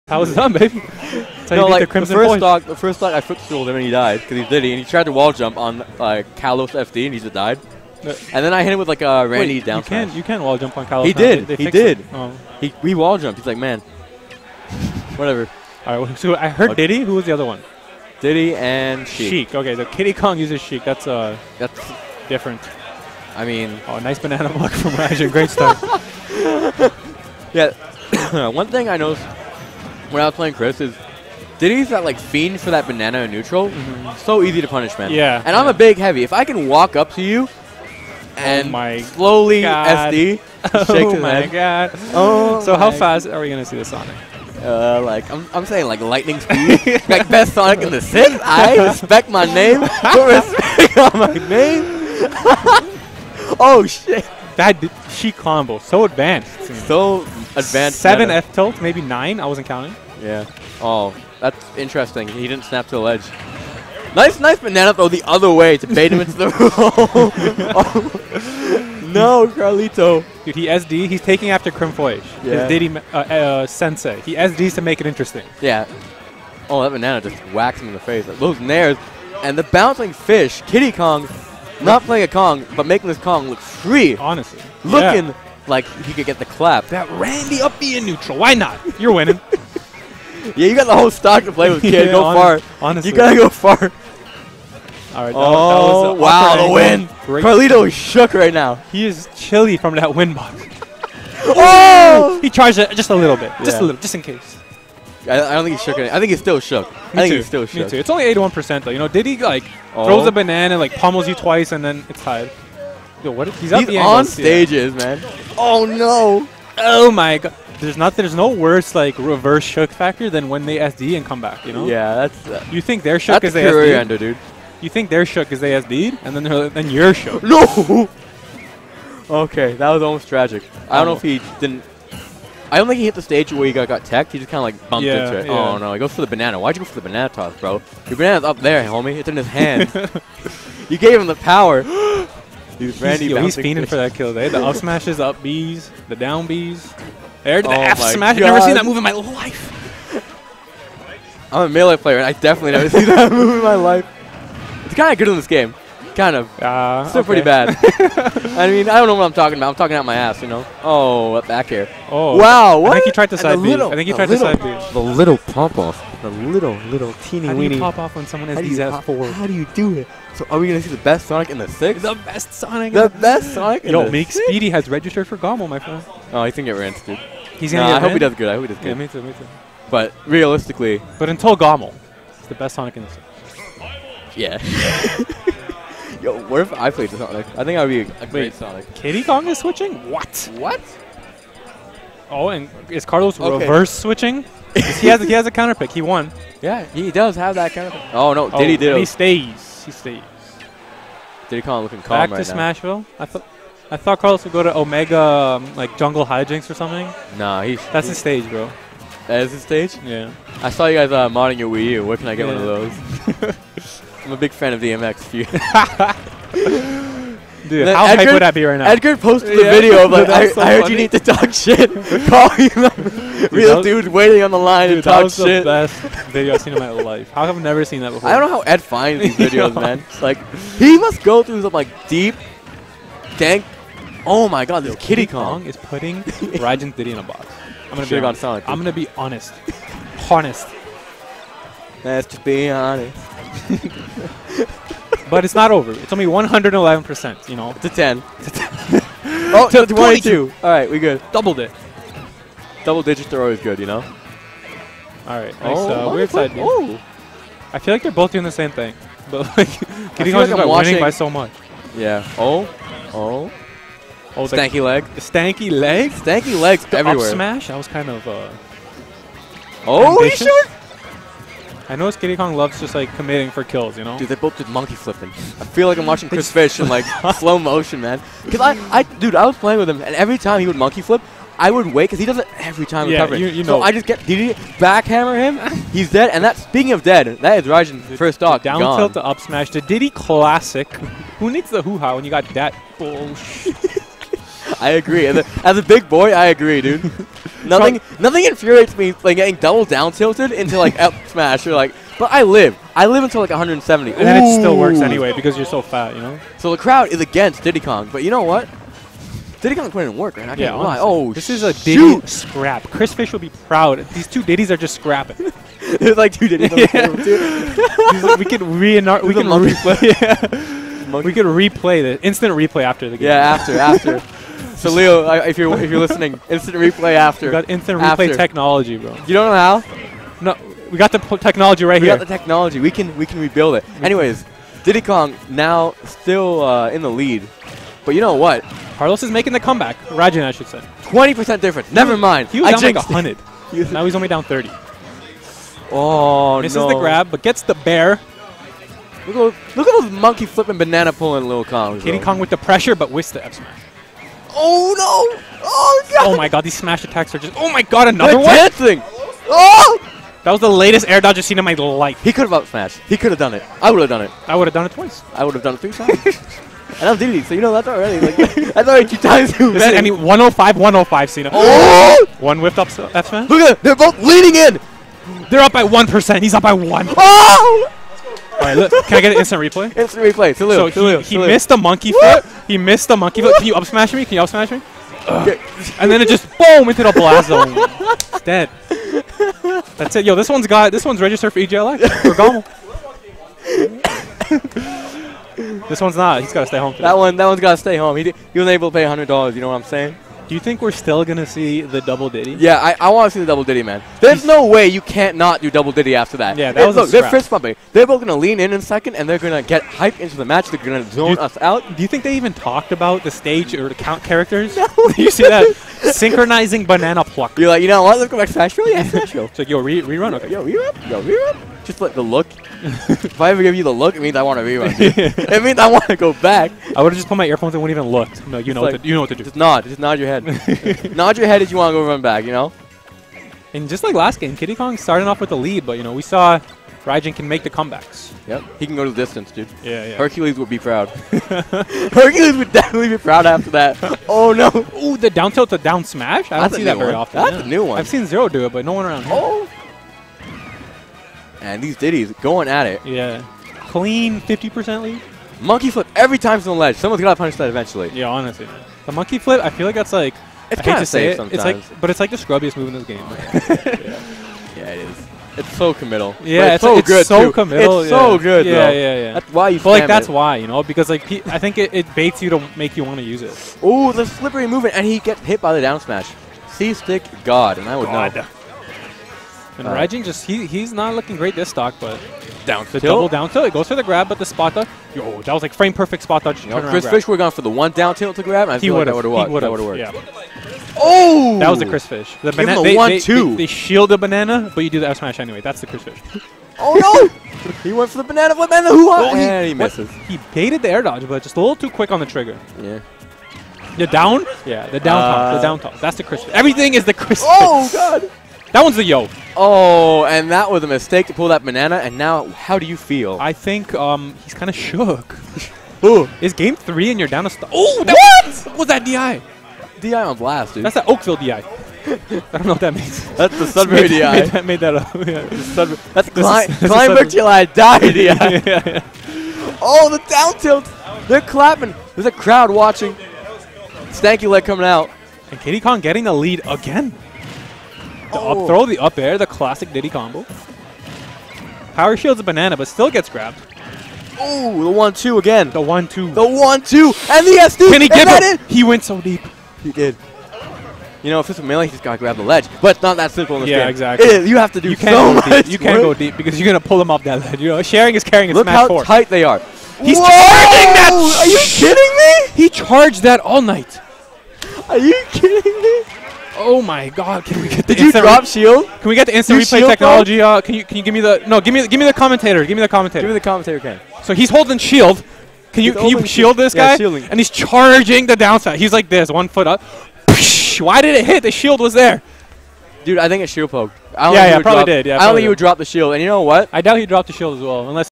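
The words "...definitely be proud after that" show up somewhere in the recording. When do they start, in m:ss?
7:22.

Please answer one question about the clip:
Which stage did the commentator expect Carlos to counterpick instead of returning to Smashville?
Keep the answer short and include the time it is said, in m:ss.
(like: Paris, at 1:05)
Jungle Hijinks, at 3:25.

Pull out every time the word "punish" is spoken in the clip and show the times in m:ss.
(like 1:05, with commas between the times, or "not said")
0:34, 7:37.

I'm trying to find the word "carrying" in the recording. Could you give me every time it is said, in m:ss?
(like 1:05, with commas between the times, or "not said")
9:18.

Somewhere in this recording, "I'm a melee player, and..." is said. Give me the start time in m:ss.
2:31.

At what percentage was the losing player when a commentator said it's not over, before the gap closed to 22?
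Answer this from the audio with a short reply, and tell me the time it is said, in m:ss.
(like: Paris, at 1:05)
111%, at 4:06.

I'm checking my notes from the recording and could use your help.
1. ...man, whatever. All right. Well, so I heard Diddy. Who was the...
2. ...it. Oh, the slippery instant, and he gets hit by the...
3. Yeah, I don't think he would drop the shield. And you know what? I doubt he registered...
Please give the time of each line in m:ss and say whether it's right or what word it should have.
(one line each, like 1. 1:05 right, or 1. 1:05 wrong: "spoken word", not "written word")
1. 0:13 right
2. 7:53 wrong: "movement", not "instant"
3. 9:45 wrong: "dropped", not "registered".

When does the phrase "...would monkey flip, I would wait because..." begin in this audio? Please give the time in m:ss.
4:40.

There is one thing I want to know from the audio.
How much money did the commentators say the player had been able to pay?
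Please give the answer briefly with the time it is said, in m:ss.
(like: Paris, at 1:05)
100 dollars, at 6:39.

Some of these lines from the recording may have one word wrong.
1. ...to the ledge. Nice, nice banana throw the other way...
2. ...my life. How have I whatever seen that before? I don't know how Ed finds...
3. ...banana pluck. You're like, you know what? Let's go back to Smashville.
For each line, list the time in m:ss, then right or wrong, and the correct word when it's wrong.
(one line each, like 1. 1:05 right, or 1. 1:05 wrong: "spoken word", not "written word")
1. 1:02 right
2. 3:46 wrong: "never", not "whatever"
3. 6:56 right.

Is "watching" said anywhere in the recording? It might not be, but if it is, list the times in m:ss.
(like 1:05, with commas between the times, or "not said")
4:36, 8:52.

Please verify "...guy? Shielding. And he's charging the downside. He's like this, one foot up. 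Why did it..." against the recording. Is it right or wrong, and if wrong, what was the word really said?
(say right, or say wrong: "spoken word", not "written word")
right.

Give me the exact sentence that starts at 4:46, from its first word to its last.
And that speaking of dead, that is Raijin's first dog.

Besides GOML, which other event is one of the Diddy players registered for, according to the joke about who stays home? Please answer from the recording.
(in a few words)
EGLX.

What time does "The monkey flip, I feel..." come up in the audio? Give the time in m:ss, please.
7:39.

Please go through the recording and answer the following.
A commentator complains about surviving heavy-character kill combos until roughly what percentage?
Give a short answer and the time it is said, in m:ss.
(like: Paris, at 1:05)
170, at 5:03.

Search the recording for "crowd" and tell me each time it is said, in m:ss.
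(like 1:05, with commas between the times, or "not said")
5:06, 8:52.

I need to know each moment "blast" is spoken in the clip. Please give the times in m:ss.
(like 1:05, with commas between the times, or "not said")
6:27, 8:40.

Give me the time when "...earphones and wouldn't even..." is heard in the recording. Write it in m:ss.
7:07.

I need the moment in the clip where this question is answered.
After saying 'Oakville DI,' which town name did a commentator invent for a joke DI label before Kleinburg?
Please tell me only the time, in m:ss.
8:43.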